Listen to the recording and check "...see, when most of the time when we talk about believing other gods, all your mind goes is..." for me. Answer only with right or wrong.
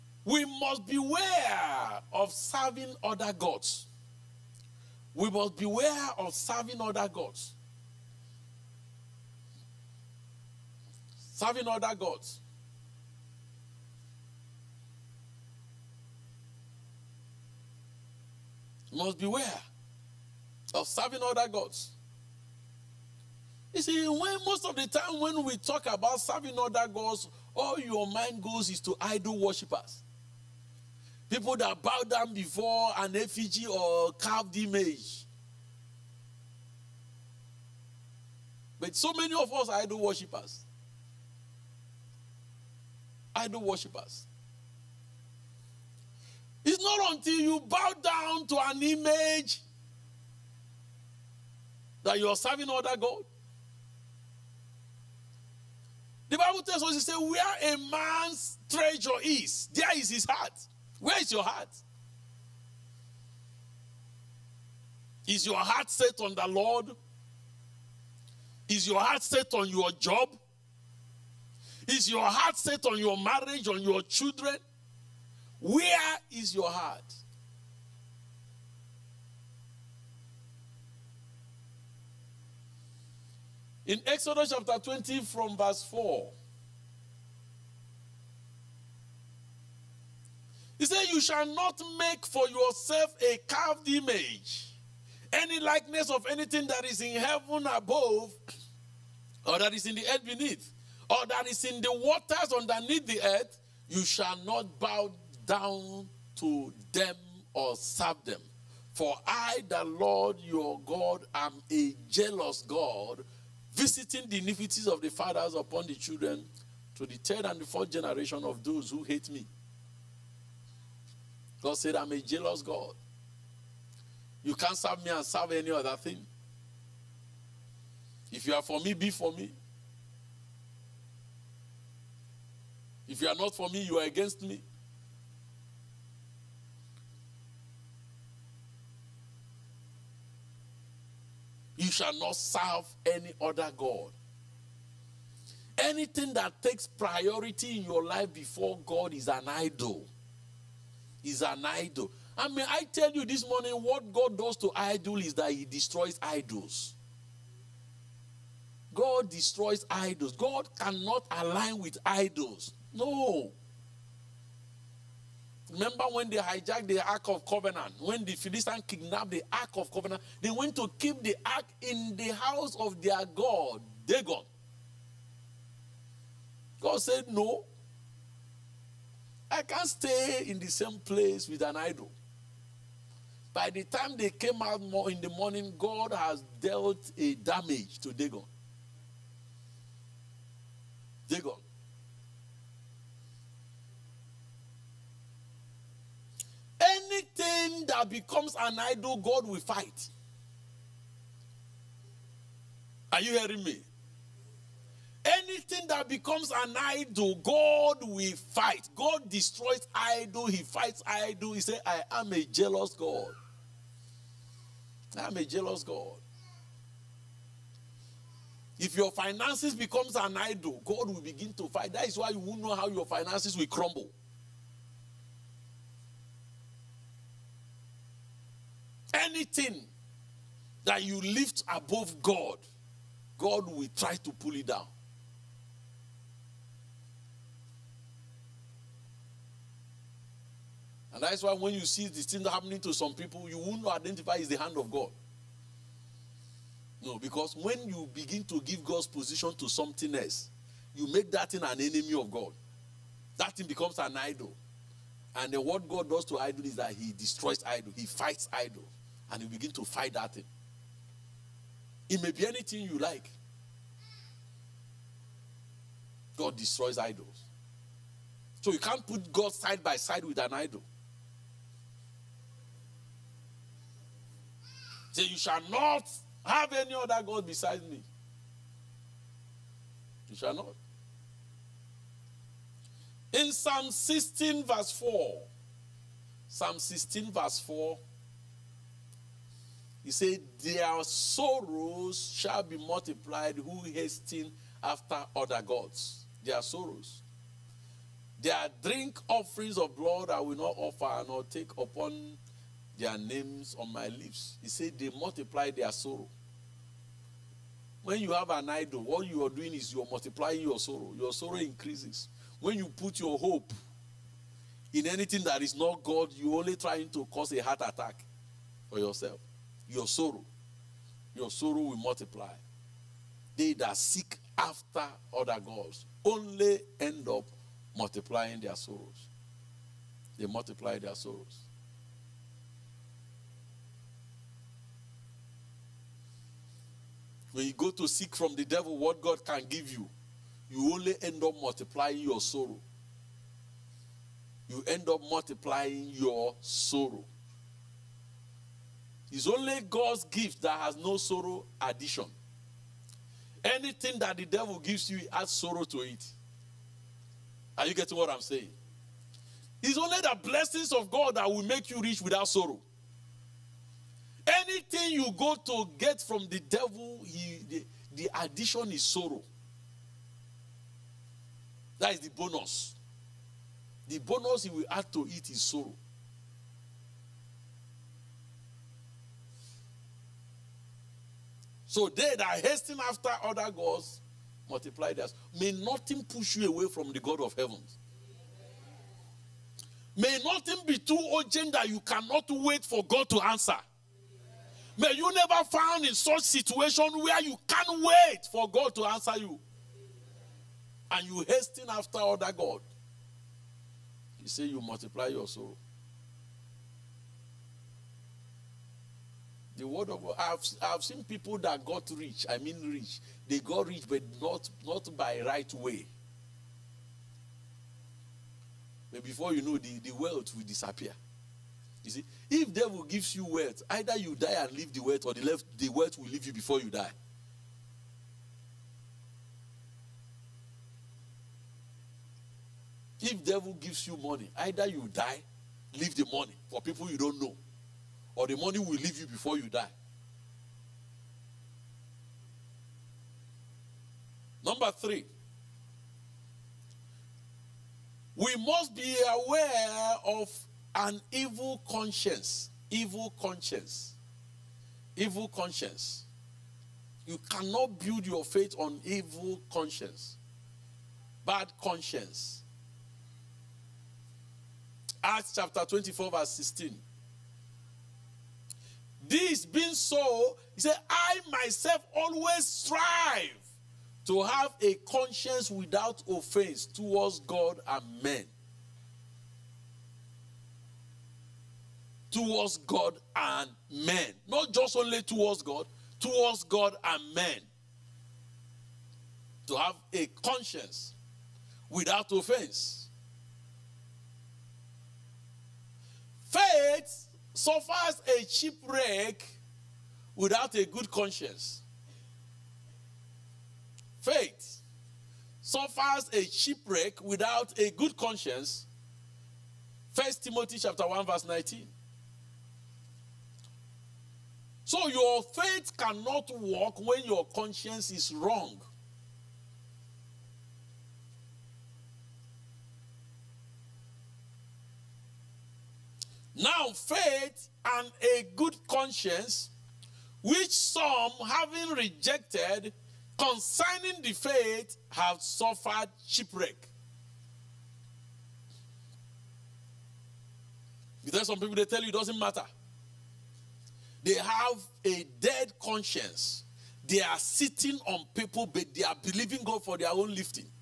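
wrong.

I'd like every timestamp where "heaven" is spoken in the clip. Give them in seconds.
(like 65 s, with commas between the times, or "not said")
97 s, 387 s.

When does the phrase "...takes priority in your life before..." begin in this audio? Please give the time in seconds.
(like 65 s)
146 s.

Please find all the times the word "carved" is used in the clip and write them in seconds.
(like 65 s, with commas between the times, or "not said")
34 s, 93 s.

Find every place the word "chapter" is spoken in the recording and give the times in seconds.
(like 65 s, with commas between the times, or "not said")
84 s, 465 s, 510 s.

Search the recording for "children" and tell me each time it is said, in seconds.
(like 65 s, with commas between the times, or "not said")
74 s, 115 s.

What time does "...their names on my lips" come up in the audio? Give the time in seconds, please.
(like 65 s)
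302 s.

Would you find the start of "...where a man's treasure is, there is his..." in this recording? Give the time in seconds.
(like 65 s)
57 s.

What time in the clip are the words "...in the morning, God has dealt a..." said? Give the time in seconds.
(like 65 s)
185 s.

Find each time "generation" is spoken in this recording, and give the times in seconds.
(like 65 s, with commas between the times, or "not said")
117 s.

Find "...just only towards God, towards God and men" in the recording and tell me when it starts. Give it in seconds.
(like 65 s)
484 s.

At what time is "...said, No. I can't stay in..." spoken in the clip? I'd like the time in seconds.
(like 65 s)
177 s.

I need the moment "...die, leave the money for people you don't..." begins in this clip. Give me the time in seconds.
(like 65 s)
435 s.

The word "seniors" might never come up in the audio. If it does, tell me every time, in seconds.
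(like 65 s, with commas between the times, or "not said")
not said.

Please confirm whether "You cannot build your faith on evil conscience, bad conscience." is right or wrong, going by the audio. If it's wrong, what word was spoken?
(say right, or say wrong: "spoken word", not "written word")
right.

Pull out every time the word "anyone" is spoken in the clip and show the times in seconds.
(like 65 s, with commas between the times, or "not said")
not said.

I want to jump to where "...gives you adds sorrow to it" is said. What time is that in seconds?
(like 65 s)
354 s.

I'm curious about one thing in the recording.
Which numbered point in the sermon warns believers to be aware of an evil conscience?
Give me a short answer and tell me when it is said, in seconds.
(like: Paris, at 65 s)
3, at 444 s.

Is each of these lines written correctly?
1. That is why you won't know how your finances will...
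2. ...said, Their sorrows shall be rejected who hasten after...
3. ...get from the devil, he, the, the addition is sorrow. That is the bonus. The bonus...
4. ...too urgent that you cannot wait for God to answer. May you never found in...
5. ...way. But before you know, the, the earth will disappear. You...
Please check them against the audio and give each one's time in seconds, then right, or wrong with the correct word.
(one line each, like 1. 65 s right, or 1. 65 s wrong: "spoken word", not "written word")
1. 221 s right
2. 290 s wrong: "multiplied", not "rejected"
3. 365 s right
4. 390 s right
5. 415 s wrong: "wealth", not "earth".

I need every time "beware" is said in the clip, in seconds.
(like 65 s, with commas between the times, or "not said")
0 s, 5 s, 19 s.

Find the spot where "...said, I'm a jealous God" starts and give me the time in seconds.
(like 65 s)
121 s.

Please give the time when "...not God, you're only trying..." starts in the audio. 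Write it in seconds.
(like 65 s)
315 s.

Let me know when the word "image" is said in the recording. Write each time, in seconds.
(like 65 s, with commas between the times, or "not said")
34 s, 48 s, 93 s.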